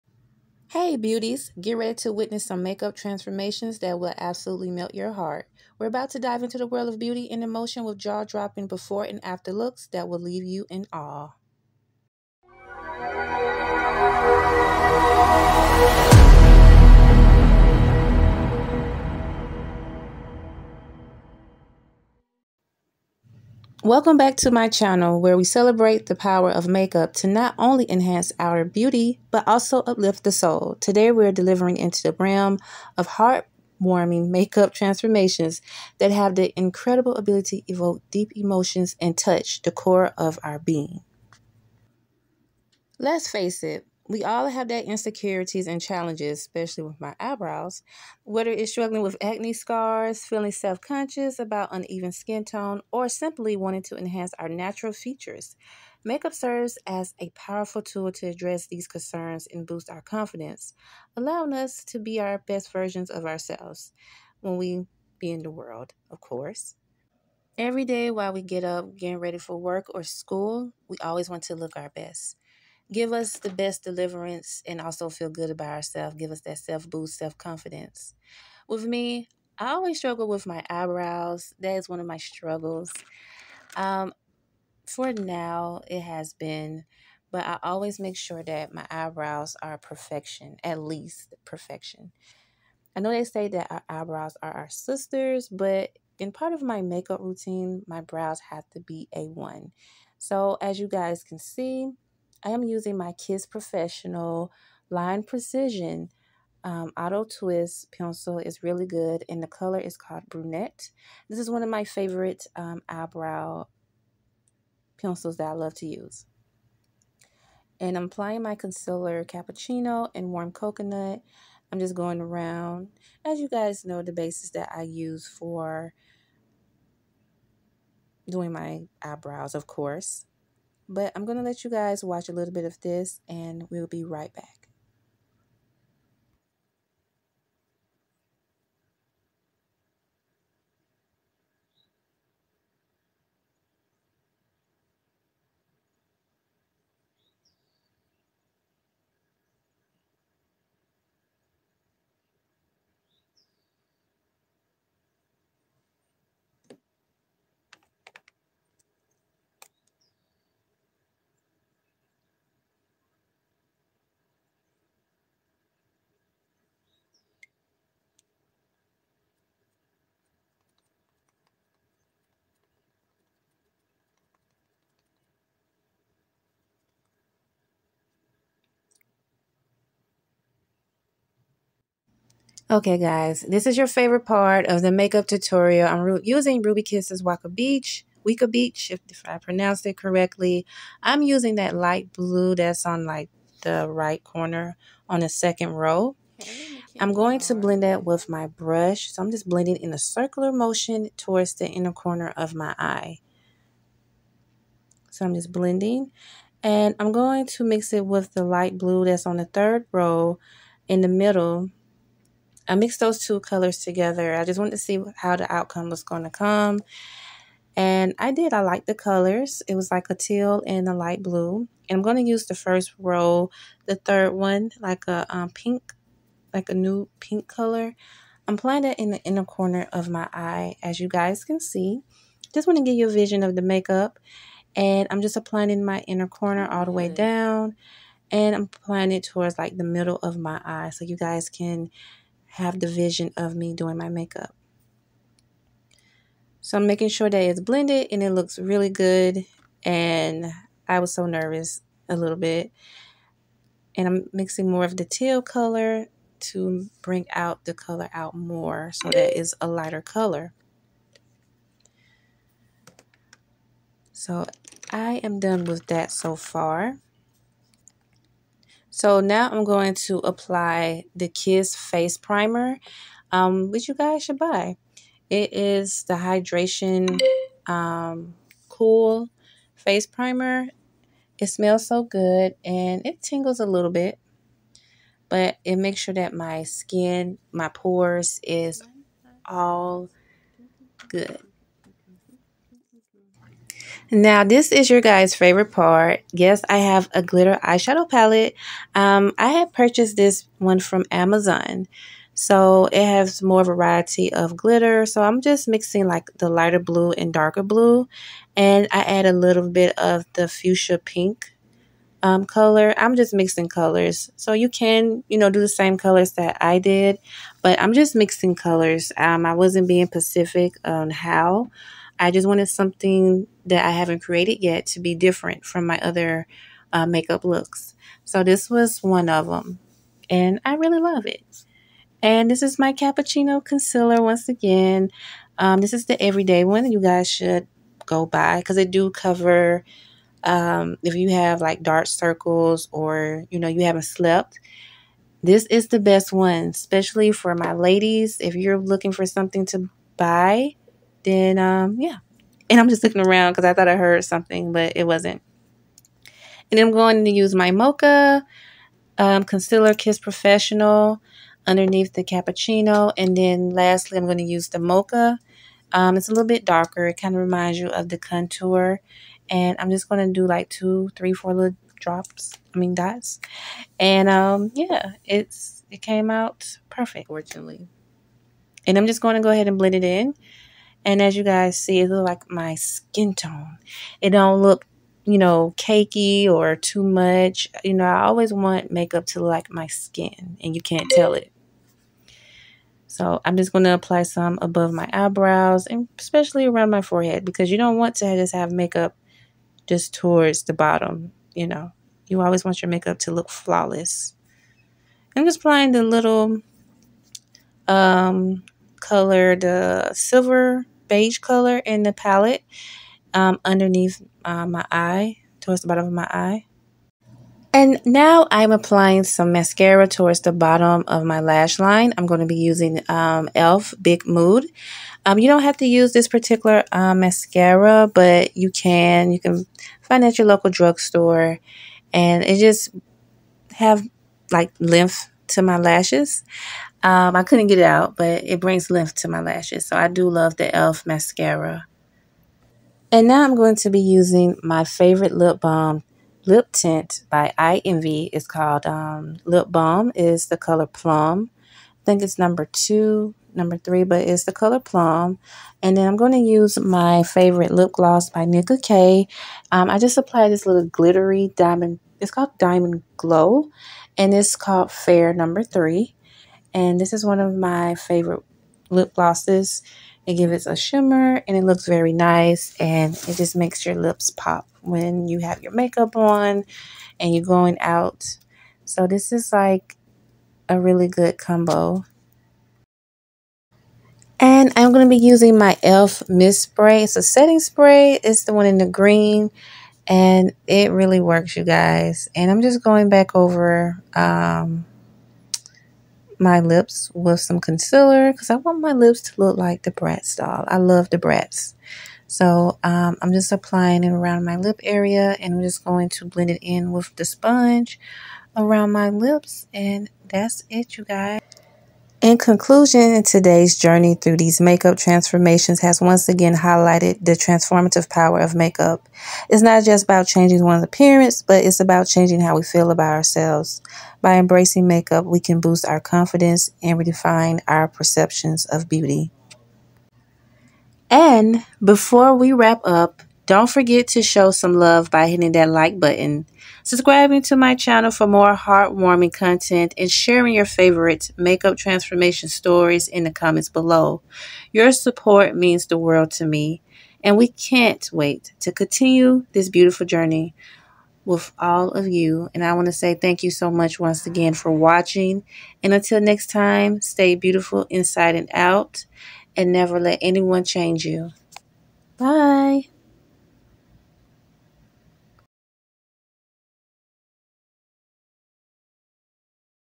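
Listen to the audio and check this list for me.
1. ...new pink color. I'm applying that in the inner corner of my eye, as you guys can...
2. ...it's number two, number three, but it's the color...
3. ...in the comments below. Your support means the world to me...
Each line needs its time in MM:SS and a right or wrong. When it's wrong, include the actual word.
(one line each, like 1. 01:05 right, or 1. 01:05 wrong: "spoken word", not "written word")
1. 03:46 right
2. 07:32 right
3. 09:03 right.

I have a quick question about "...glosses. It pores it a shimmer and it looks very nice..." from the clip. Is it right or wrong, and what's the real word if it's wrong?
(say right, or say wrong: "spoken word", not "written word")
wrong: "gives", not "pores".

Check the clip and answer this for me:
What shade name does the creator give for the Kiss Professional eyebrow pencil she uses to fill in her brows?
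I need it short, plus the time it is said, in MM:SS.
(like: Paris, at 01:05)
Brunette, at 01:50.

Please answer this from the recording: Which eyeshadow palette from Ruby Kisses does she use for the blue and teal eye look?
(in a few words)
Waka Beach.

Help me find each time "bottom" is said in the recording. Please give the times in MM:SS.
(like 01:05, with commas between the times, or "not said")
06:40, 06:55, 07:00.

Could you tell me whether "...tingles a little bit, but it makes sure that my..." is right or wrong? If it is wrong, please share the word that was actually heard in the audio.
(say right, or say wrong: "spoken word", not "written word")
right.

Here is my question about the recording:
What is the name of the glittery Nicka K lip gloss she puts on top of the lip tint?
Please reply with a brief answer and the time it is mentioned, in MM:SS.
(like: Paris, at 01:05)
Diamond Glow, at 07:42.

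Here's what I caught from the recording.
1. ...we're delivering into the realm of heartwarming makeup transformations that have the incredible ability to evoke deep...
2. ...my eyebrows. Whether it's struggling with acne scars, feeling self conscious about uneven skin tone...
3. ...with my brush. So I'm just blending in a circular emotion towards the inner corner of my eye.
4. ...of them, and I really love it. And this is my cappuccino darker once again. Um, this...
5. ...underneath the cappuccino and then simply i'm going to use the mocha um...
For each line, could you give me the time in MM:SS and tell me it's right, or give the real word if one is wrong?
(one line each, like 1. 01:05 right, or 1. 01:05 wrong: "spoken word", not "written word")
1. 00:31 right
2. 00:46 right
3. 03:18 wrong: "motion", not "emotion"
4. 05:29 wrong: "concealer", not "darker"
5. 06:01 wrong: "lastly", not "simply".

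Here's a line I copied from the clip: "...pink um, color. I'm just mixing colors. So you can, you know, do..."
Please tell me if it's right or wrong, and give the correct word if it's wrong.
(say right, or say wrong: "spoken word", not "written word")
right.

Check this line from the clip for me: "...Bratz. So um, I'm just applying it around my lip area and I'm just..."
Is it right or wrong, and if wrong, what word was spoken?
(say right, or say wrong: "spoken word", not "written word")
right.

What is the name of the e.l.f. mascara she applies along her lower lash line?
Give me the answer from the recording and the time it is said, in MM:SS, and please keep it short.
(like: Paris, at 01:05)
Big Mood, at 07:04.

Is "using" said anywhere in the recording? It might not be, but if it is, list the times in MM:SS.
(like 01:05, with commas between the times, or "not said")
01:42, 03:06, 03:11, 07:02, 07:24, 08:05.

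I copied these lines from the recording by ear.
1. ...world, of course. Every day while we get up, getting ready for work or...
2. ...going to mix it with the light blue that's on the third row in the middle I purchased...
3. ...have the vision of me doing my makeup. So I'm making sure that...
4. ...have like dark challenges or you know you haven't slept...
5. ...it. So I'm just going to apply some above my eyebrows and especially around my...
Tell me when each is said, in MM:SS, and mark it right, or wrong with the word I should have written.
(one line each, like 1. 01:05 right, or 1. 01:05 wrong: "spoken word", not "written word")
1. 01:05 right
2. 03:27 wrong: "mixed", not "purchased"
3. 04:02 right
4. 05:41 wrong: "circles", not "challenges"
5. 06:31 right.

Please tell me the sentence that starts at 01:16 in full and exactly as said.
Give us that self boost, self confidence.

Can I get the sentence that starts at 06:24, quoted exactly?
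It don't look, you know, cakey or too much.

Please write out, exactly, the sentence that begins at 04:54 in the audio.
Now, this is your guys' favorite part.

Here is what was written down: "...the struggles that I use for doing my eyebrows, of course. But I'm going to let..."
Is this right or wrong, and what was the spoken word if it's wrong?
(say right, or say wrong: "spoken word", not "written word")
wrong: "bases", not "struggles".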